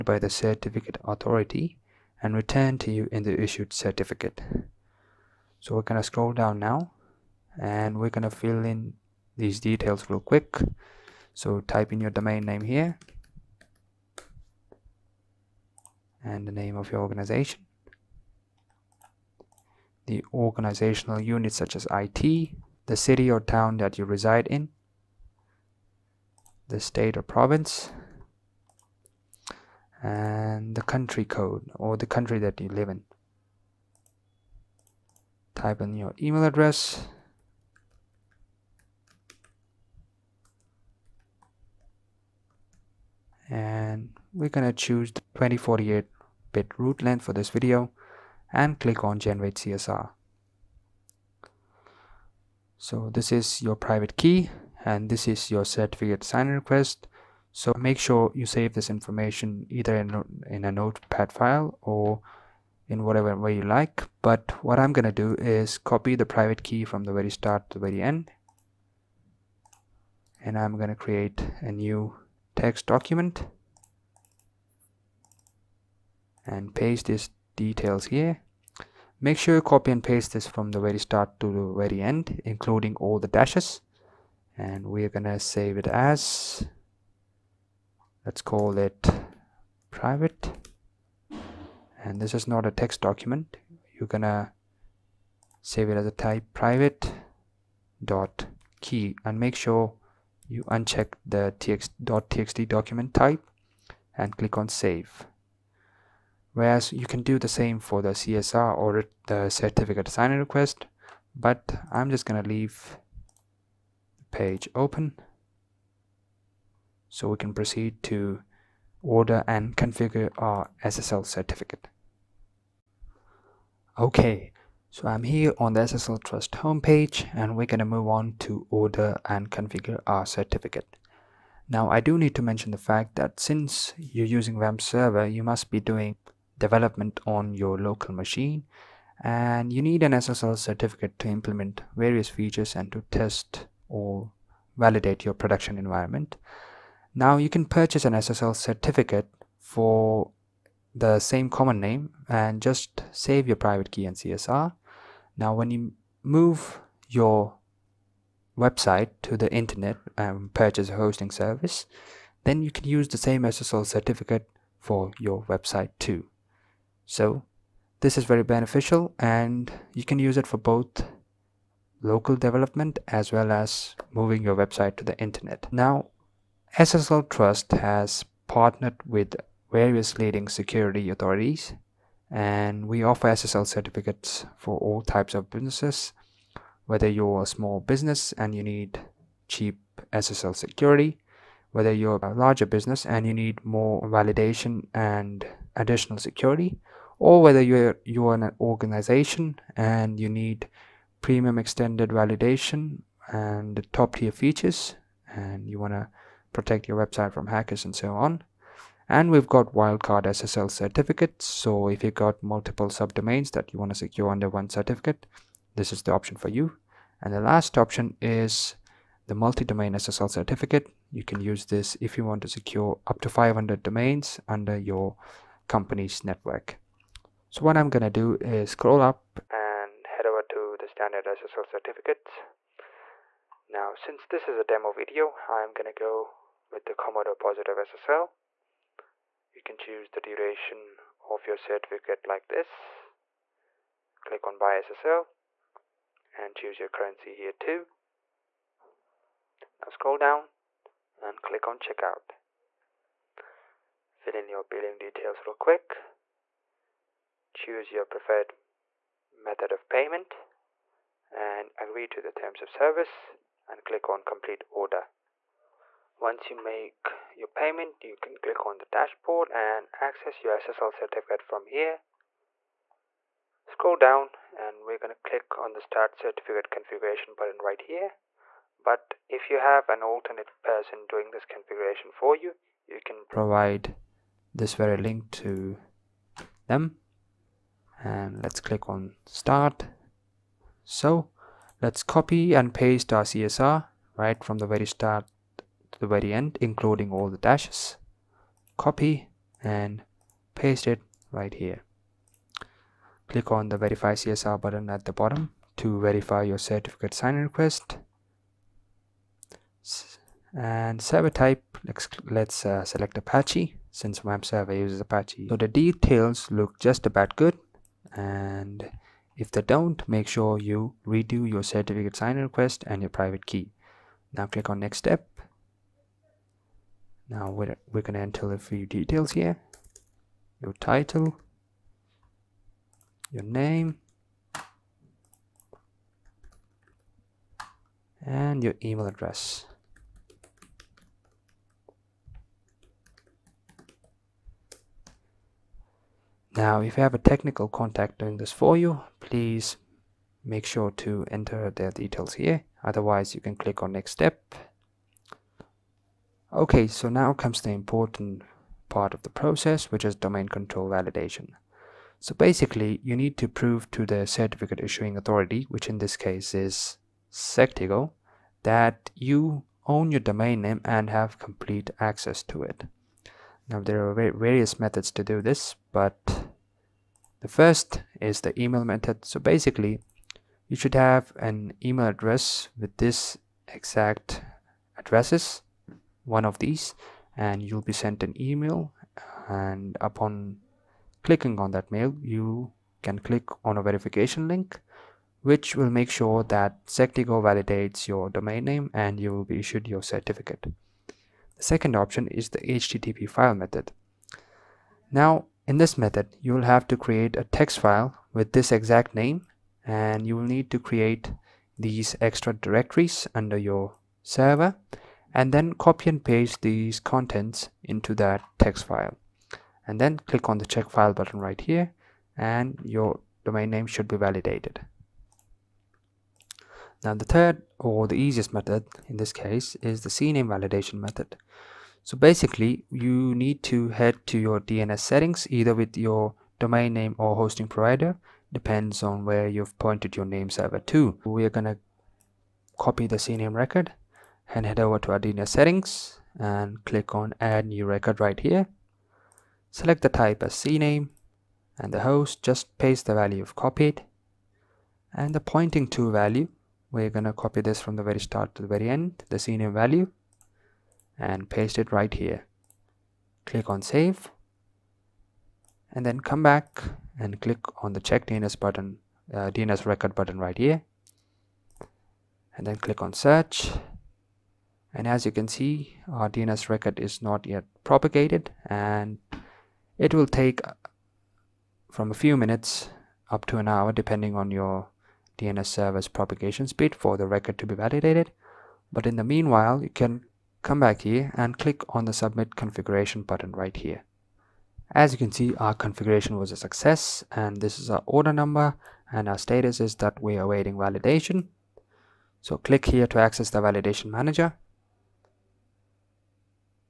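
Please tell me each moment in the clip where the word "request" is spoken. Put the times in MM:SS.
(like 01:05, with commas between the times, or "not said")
00:56, 01:50, 05:07, 05:22.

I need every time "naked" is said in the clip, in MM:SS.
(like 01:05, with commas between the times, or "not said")
not said.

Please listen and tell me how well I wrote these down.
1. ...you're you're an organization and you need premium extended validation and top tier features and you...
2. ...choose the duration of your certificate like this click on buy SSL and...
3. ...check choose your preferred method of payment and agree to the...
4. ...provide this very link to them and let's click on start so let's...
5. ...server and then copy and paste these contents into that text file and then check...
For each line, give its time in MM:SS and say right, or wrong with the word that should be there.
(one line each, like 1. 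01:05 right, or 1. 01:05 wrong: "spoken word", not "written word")
1. 03:17 right
2. 03:59 right
3. 04:15 wrong: "quick", not "check"
4. 04:43 right
5. 06:54 wrong: "click", not "check".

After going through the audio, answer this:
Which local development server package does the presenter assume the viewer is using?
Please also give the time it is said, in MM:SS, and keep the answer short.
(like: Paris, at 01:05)
WAMP server, at 02:14.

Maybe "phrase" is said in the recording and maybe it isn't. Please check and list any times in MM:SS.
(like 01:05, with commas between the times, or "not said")
not said.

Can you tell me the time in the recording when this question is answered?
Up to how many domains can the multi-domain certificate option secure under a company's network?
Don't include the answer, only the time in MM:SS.
03:43.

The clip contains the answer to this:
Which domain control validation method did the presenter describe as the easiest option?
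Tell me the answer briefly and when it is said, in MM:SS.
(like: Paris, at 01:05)
CNAME validation, at 07:10.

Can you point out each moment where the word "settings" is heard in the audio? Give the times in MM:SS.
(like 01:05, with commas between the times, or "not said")
07:14, 07:25.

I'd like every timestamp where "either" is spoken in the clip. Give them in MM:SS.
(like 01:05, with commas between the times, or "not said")
00:59, 07:15.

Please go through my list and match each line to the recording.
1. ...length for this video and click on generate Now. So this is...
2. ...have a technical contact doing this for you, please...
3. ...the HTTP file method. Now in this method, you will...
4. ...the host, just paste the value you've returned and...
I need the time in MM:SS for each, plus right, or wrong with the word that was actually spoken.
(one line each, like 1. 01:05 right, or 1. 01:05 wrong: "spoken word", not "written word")
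1. 00:47 wrong: "CSR", not "Now"
2. 05:47 right
3. 06:42 right
4. 07:31 wrong: "copied", not "returned".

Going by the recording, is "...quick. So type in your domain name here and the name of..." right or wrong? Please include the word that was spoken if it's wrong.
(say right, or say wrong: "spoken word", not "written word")
right.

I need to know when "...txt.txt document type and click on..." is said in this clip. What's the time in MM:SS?
01:41.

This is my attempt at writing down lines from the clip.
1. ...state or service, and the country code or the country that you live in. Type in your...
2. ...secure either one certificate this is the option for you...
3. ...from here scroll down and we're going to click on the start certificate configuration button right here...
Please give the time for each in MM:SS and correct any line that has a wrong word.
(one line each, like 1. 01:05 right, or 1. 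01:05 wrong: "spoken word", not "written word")
1. 00:26 wrong: "province", not "service"
2. 03:33 wrong: "under", not "either"
3. 04:31 right.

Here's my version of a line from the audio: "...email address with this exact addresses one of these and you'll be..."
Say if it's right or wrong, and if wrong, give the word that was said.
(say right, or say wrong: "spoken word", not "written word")
right.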